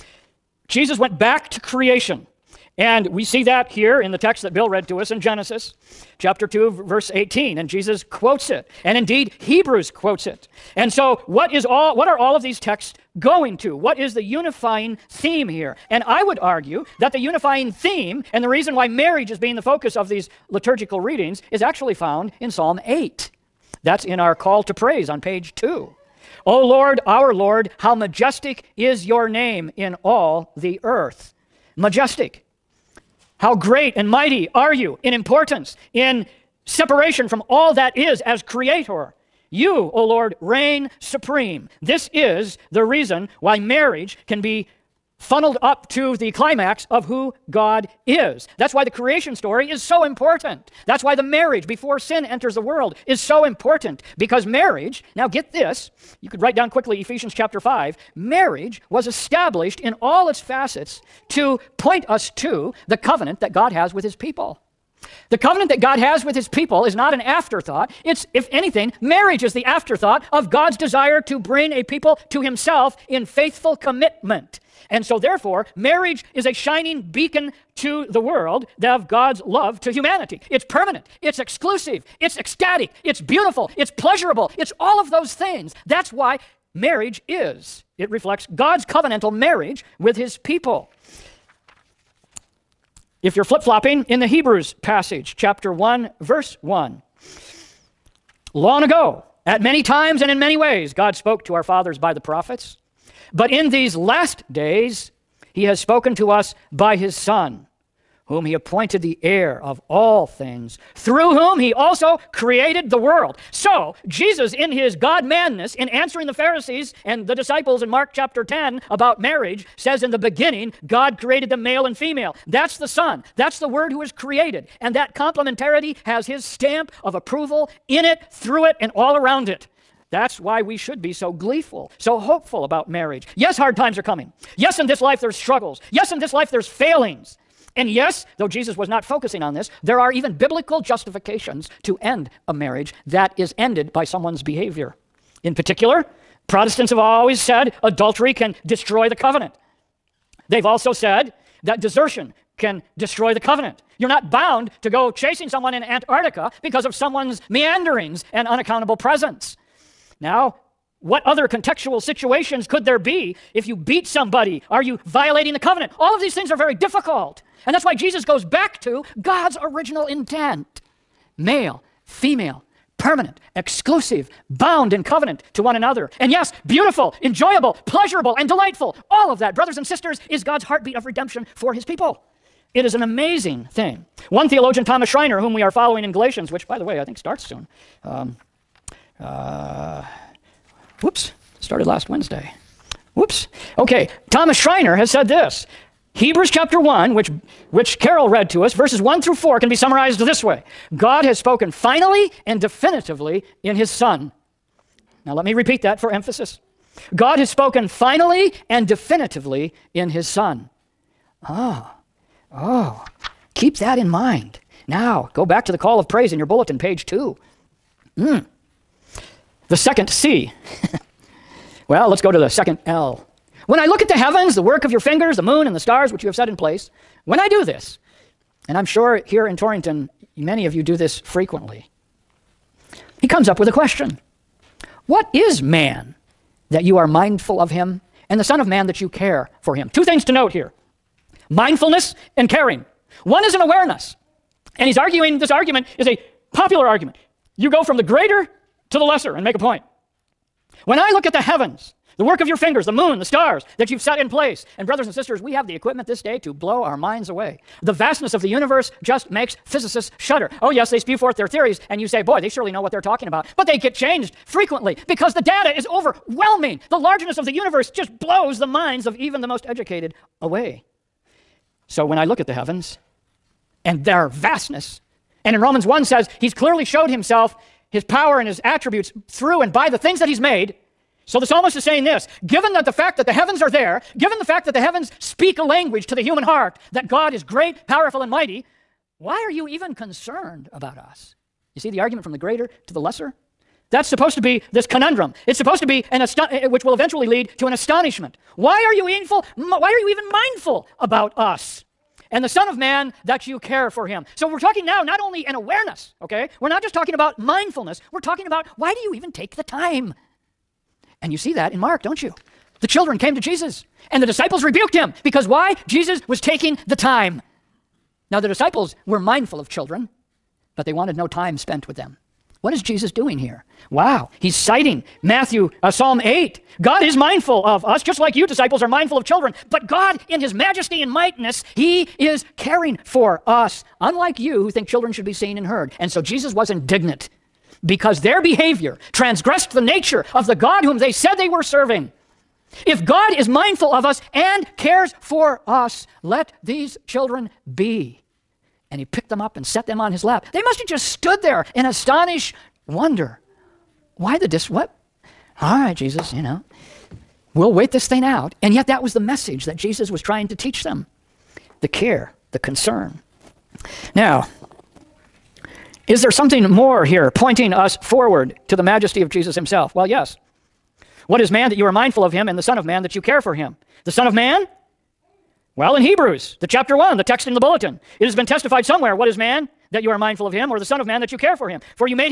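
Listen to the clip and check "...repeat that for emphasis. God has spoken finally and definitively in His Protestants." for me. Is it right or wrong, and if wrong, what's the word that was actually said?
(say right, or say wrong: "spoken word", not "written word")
wrong: "Son", not "Protestants".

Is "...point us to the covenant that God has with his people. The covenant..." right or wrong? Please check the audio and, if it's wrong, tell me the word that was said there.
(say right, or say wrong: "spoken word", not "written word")
right.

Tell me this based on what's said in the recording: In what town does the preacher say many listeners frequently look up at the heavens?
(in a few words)
Torrington.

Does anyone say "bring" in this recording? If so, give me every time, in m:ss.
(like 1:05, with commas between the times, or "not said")
1:11.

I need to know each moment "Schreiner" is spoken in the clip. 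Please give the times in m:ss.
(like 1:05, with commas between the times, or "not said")
3:05, 3:14.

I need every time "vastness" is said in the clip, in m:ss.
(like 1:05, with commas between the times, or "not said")
4:17, 4:34.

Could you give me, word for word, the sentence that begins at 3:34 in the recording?
Now, go back to the call of praise in your bulletin, page two.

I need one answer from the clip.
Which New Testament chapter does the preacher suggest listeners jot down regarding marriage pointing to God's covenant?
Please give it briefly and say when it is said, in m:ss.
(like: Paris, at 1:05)
Ephesians chapter 5, at 0:57.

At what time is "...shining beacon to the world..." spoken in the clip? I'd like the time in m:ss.
1:16.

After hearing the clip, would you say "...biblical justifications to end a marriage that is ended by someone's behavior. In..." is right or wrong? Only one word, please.
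right.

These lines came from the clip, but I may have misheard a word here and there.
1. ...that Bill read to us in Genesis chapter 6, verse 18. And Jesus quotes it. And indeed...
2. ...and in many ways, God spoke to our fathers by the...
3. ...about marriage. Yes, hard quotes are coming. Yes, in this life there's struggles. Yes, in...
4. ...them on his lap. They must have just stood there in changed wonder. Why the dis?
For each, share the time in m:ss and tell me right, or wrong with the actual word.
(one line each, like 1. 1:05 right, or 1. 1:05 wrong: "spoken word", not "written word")
1. 0:04 wrong: "2", not "6"
2. 1:40 right
3. 2:12 wrong: "times", not "quotes"
4. 5:49 wrong: "astonished", not "changed".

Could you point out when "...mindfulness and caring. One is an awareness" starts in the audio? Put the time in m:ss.
4:01.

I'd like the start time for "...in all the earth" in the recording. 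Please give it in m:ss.
0:29.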